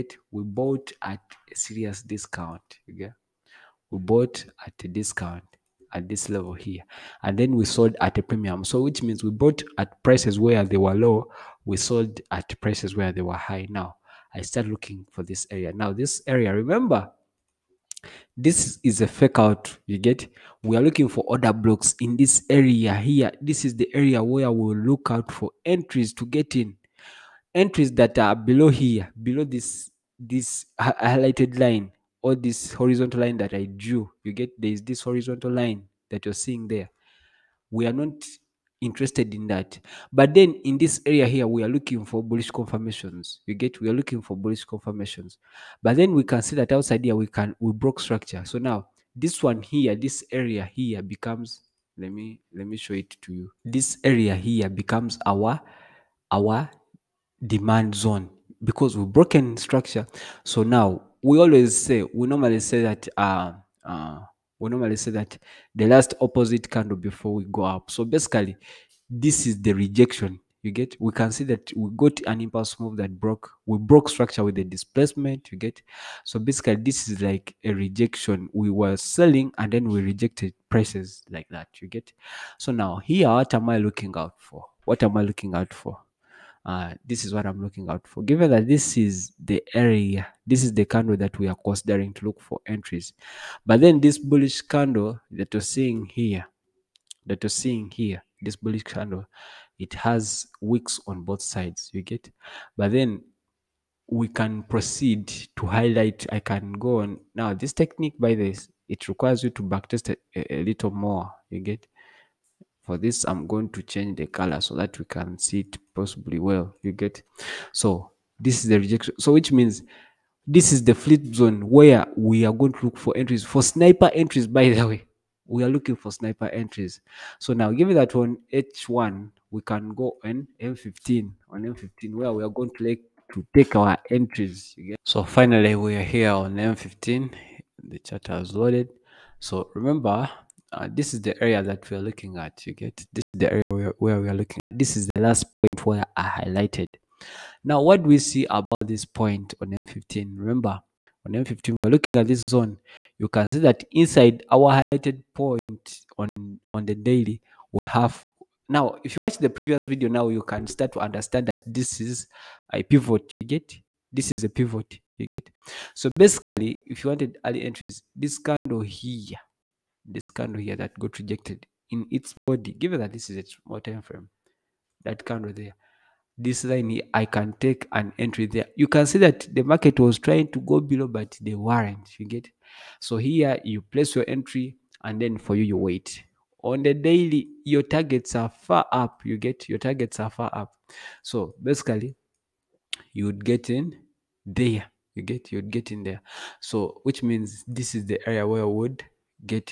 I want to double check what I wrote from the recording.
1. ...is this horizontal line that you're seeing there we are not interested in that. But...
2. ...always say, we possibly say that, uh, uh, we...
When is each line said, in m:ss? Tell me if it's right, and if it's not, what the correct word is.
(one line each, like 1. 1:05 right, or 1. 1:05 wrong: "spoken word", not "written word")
1. 0:34 right
2. 1:01 wrong: "normally", not "possibly".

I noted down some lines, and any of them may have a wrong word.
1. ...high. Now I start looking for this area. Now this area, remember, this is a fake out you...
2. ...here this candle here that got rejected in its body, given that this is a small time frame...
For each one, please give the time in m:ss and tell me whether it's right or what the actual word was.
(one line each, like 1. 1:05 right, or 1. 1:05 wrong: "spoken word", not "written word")
1. 0:13 right
2. 2:48 right.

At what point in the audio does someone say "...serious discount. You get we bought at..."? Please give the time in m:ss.
0:01.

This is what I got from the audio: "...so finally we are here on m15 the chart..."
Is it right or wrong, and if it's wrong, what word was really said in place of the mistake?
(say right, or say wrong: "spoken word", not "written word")
right.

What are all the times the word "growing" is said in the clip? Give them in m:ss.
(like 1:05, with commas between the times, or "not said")
not said.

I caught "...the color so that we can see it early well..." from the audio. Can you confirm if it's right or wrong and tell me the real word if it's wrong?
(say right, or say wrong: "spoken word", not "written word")
wrong: "possibly", not "early".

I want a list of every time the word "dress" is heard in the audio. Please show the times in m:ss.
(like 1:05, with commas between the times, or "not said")
not said.